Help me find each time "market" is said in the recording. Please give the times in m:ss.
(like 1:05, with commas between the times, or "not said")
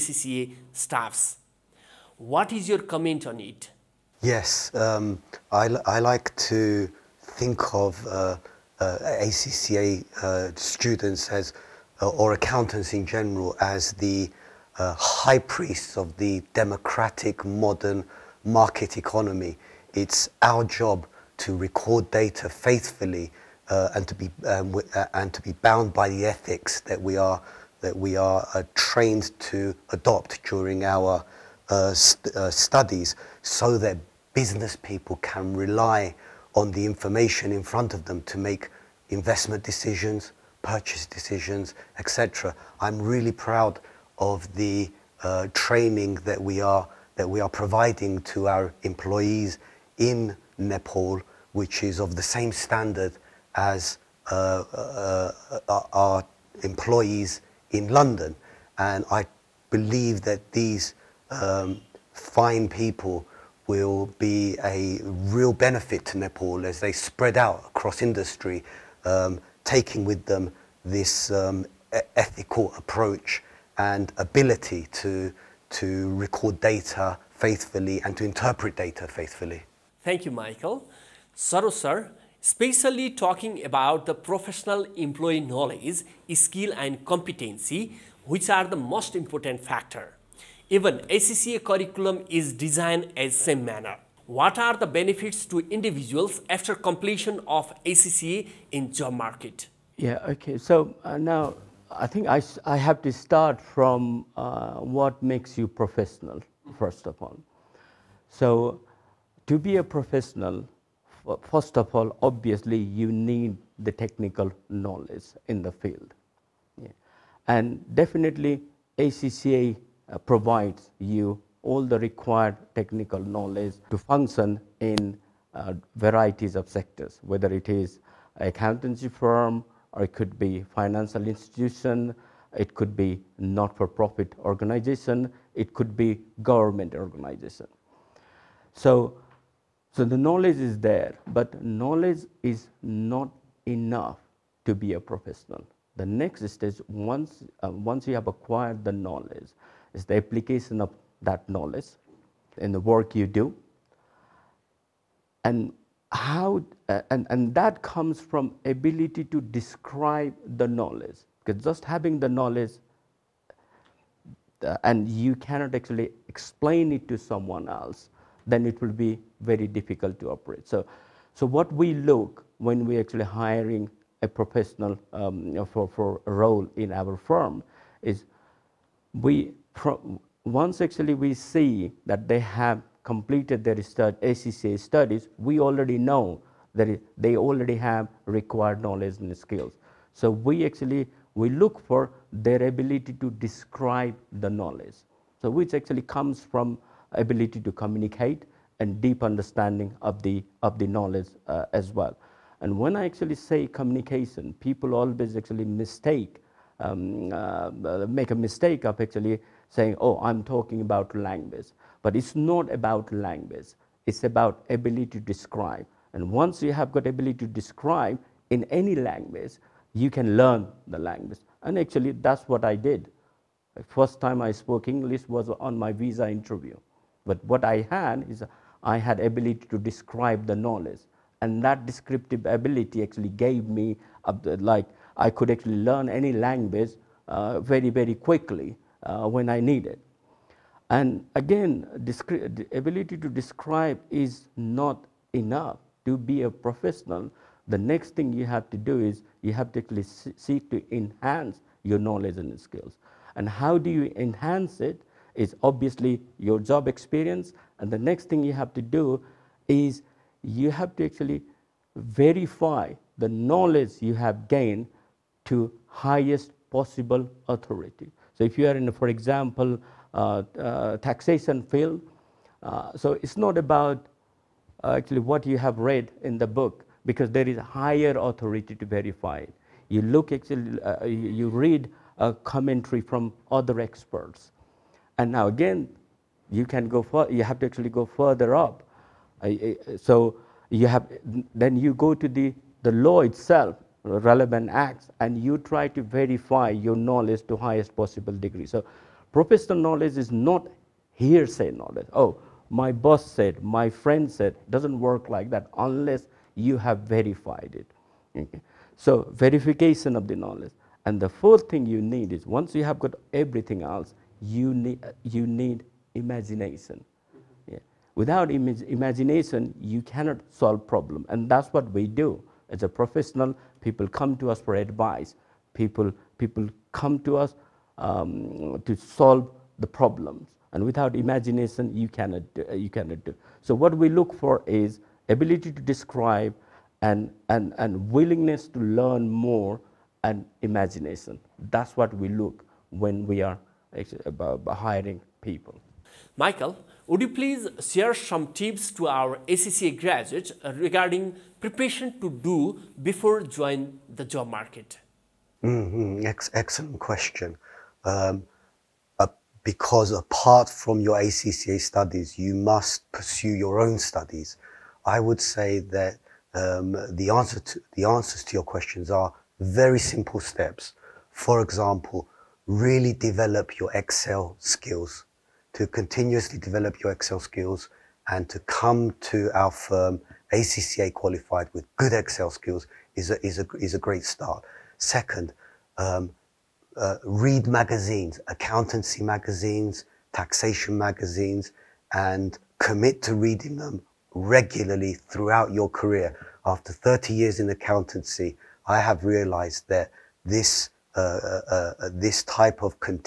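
0:18, 1:39, 5:54.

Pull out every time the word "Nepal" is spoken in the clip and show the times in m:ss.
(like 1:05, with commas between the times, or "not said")
0:50, 1:06.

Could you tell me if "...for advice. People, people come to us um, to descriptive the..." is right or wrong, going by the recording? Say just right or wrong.
wrong.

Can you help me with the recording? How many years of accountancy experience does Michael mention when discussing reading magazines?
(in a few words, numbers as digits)
30.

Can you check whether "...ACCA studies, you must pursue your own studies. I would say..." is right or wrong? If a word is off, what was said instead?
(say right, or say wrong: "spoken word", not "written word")
right.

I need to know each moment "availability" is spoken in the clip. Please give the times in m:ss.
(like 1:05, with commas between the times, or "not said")
not said.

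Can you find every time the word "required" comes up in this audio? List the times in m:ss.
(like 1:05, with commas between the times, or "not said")
2:01, 3:08.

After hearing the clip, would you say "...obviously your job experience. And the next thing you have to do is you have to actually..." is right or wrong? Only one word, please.
right.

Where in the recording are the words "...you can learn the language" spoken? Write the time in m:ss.
3:39.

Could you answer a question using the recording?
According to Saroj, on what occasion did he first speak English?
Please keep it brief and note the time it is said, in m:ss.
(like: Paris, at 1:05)
visa interview, at 3:45.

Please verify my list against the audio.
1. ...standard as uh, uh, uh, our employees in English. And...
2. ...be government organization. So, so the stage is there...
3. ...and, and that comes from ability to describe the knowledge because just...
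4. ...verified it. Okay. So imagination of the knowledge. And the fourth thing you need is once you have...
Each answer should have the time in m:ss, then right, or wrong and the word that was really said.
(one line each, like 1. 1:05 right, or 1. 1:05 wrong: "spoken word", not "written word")
1. 0:52 wrong: "London", not "English"
2. 2:15 wrong: "knowledge", not "stage"
3. 2:37 right
4. 5:06 wrong: "verification", not "imagination".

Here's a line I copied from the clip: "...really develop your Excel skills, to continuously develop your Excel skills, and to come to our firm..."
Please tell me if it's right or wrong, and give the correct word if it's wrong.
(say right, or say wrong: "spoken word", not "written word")
right.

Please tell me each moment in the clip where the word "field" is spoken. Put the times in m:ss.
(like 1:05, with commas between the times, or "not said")
1:55, 4:31.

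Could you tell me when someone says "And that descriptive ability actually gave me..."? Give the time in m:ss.
3:51.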